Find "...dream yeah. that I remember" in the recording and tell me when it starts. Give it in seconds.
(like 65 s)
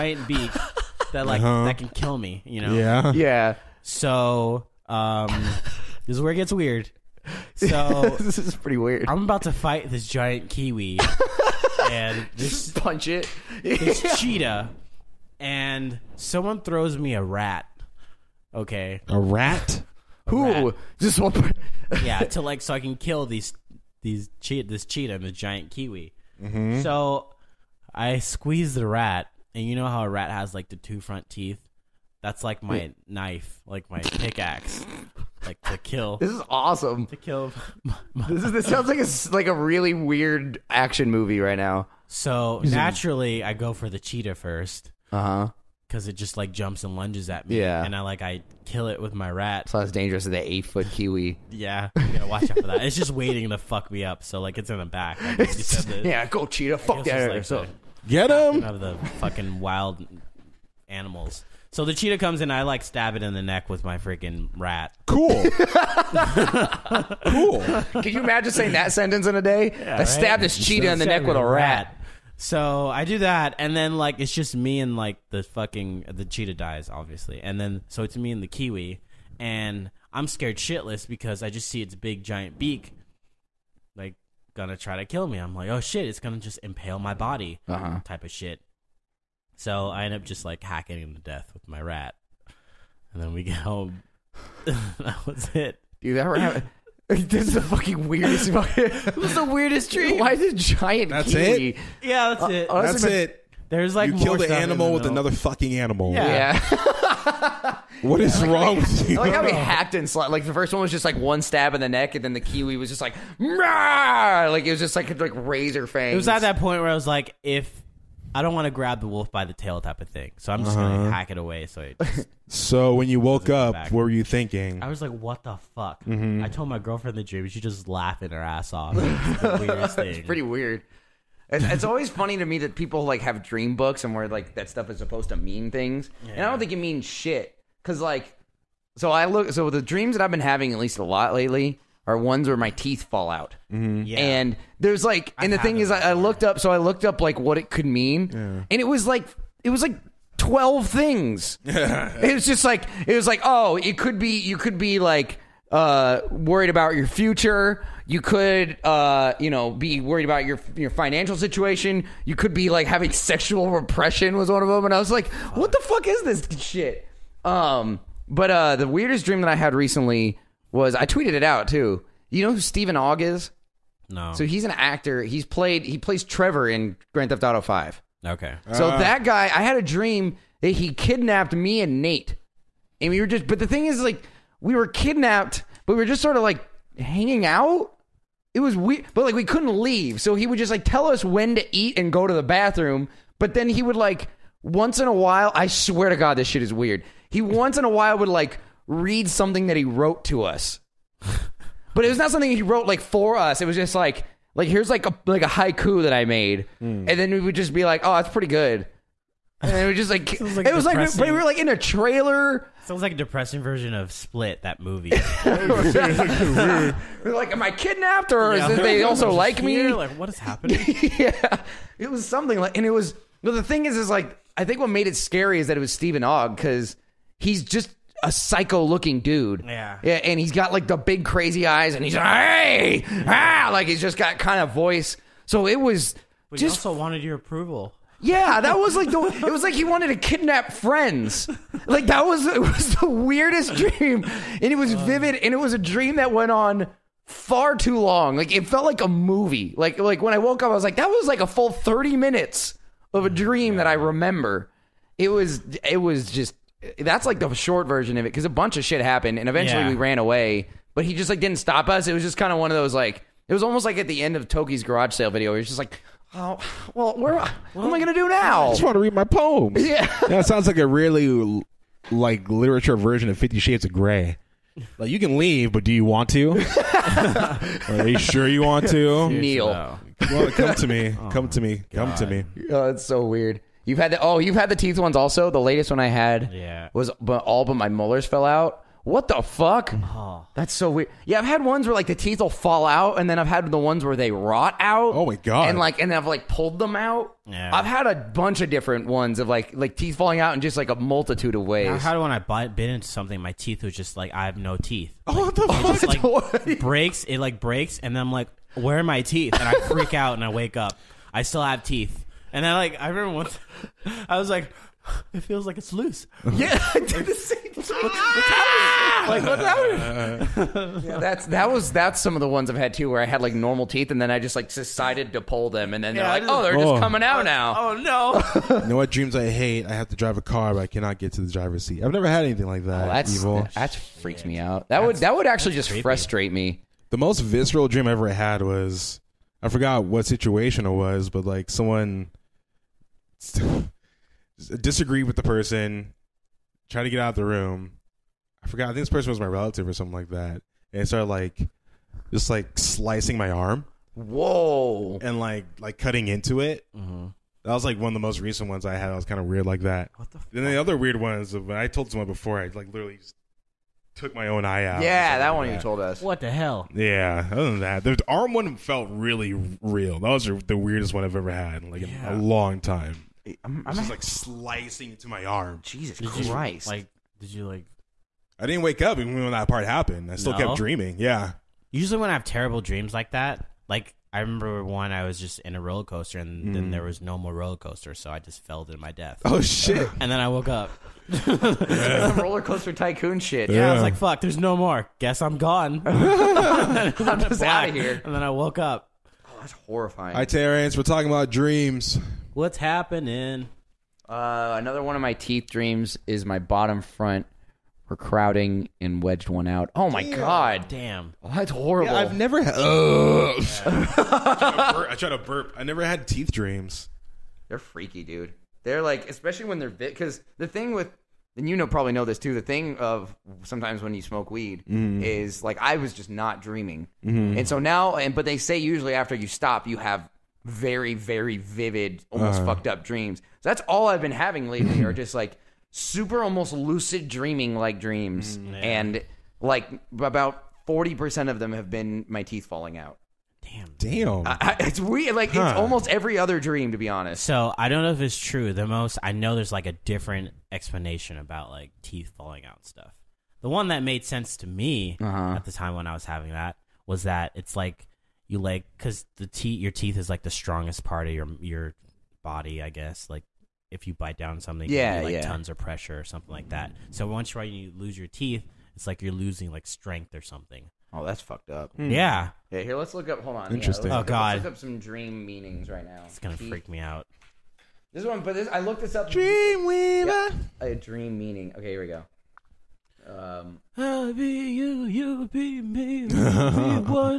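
253 s.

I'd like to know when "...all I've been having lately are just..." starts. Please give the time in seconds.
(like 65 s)
433 s.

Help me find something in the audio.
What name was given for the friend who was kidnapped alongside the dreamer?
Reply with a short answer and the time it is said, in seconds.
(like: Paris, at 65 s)
Nate, at 182 s.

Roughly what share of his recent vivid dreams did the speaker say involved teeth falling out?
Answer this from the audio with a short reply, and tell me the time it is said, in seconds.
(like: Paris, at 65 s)
40%, at 440 s.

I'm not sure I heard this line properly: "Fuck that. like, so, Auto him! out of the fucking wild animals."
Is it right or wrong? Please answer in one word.
wrong.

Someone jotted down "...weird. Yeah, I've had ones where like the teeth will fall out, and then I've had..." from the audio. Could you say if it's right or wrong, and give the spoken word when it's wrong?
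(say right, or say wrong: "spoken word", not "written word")
right.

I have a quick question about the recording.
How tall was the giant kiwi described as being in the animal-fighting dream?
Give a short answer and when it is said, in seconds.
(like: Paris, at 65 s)
8 feet, at 50 s.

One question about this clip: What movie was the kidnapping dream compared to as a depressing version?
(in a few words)
Split.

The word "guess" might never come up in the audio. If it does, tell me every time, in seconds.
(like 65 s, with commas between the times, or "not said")
395 s, 462 s.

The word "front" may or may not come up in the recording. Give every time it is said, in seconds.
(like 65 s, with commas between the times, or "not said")
31 s, 407 s.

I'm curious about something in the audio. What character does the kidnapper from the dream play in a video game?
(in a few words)
Trevor.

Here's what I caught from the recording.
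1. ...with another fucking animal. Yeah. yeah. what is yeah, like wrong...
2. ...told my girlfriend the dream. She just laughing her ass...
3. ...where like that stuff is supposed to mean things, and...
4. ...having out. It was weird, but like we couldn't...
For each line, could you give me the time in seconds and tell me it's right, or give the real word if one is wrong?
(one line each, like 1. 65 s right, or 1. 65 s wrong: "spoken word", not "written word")
1. 104 s right
2. 126 s right
3. 134 s right
4. 186 s wrong: "hanging", not "having".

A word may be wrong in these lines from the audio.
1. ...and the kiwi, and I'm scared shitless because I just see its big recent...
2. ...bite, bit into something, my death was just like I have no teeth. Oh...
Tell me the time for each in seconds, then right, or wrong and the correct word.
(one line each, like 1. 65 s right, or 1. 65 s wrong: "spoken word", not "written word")
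1. 78 s wrong: "giant", not "recent"
2. 302 s wrong: "teeth", not "death".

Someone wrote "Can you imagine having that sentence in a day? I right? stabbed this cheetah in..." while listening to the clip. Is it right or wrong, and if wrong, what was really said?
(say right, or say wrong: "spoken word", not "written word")
wrong: "saying", not "having".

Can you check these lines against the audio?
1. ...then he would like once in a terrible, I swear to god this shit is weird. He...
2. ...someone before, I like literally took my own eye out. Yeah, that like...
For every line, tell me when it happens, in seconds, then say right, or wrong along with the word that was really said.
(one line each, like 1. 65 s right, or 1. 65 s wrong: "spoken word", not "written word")
1. 193 s wrong: "while", not "terrible"
2. 362 s right.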